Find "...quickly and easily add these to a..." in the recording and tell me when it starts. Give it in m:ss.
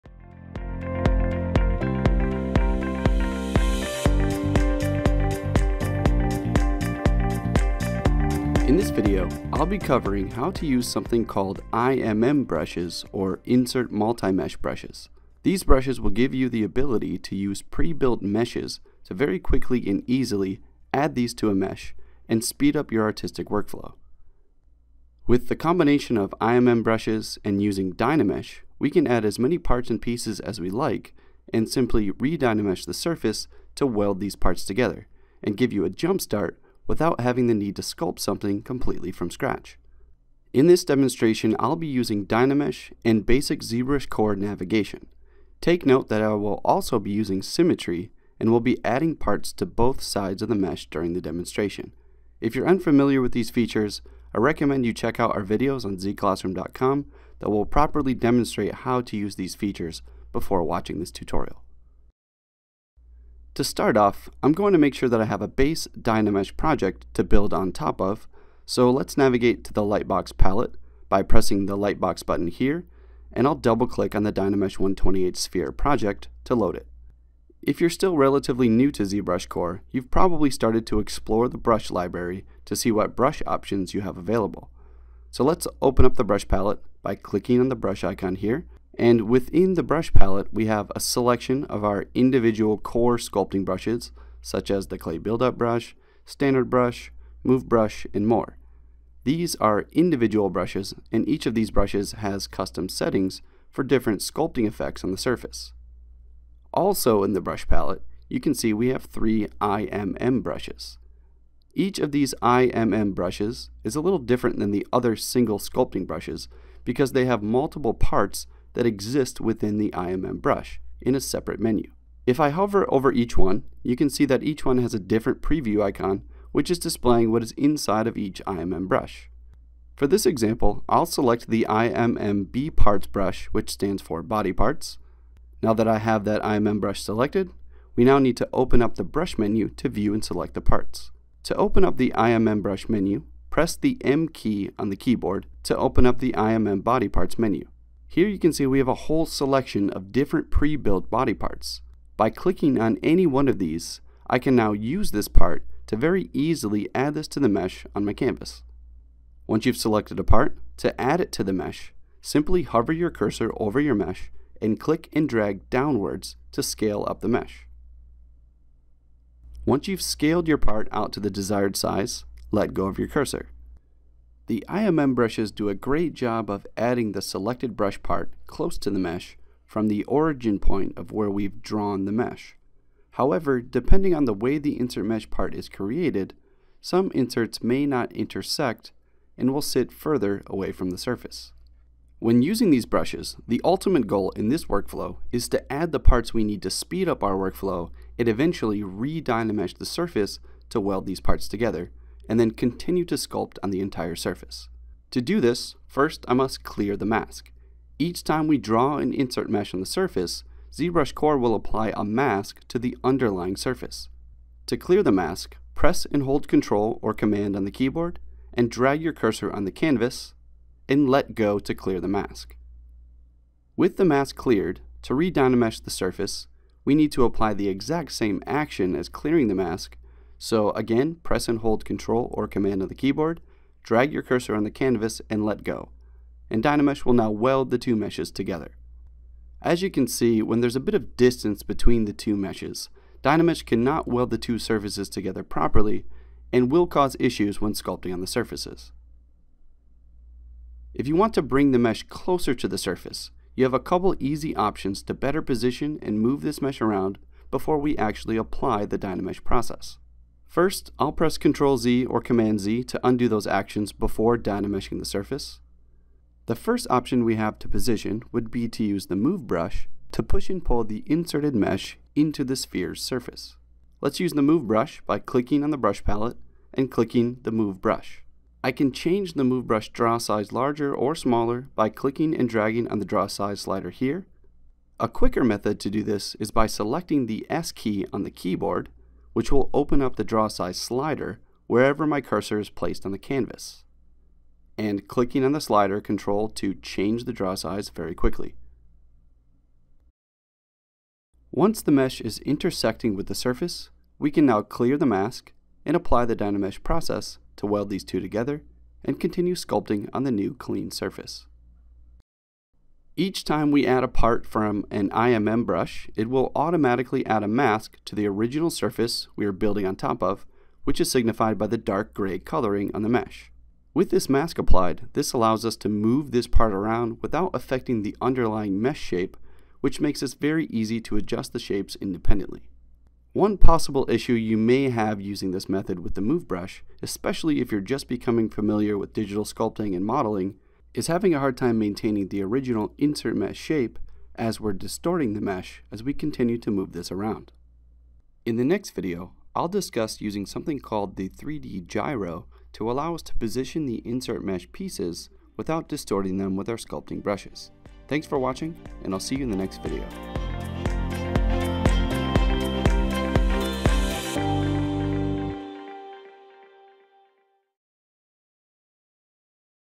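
0:19.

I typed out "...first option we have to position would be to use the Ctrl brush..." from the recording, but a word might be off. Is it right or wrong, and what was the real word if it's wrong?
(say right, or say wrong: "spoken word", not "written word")
wrong: "Move", not "Ctrl".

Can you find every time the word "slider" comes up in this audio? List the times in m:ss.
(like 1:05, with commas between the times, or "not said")
4:43, 4:50, 4:55.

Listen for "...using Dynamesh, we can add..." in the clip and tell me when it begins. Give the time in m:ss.
0:27.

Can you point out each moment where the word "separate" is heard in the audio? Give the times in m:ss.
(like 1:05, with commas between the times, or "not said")
2:01.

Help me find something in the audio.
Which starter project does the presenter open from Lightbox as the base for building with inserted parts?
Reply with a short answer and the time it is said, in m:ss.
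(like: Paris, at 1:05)
Dynamesh 128 Sphere, at 1:14.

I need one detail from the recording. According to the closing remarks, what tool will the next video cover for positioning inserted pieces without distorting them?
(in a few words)
3D Gizmo.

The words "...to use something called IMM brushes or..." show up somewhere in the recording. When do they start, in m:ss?
0:10.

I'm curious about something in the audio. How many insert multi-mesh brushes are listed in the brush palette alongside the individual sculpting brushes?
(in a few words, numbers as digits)
3.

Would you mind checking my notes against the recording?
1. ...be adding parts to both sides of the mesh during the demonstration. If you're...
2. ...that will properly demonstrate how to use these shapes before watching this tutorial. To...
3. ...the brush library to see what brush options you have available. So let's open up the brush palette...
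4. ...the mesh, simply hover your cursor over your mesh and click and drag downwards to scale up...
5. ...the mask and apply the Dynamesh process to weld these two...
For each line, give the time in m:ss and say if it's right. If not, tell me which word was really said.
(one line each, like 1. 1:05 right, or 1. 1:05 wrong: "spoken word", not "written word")
1. 0:48 right
2. 0:57 wrong: "features", not "shapes"
3. 1:21 right
4. 2:41 right
5. 5:04 right.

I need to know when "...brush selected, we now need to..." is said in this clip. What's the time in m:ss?
2:16.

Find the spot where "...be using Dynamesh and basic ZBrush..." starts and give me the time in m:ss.
0:41.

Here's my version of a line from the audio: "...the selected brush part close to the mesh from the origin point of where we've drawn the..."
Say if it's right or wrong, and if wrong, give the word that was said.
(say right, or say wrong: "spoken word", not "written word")
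right.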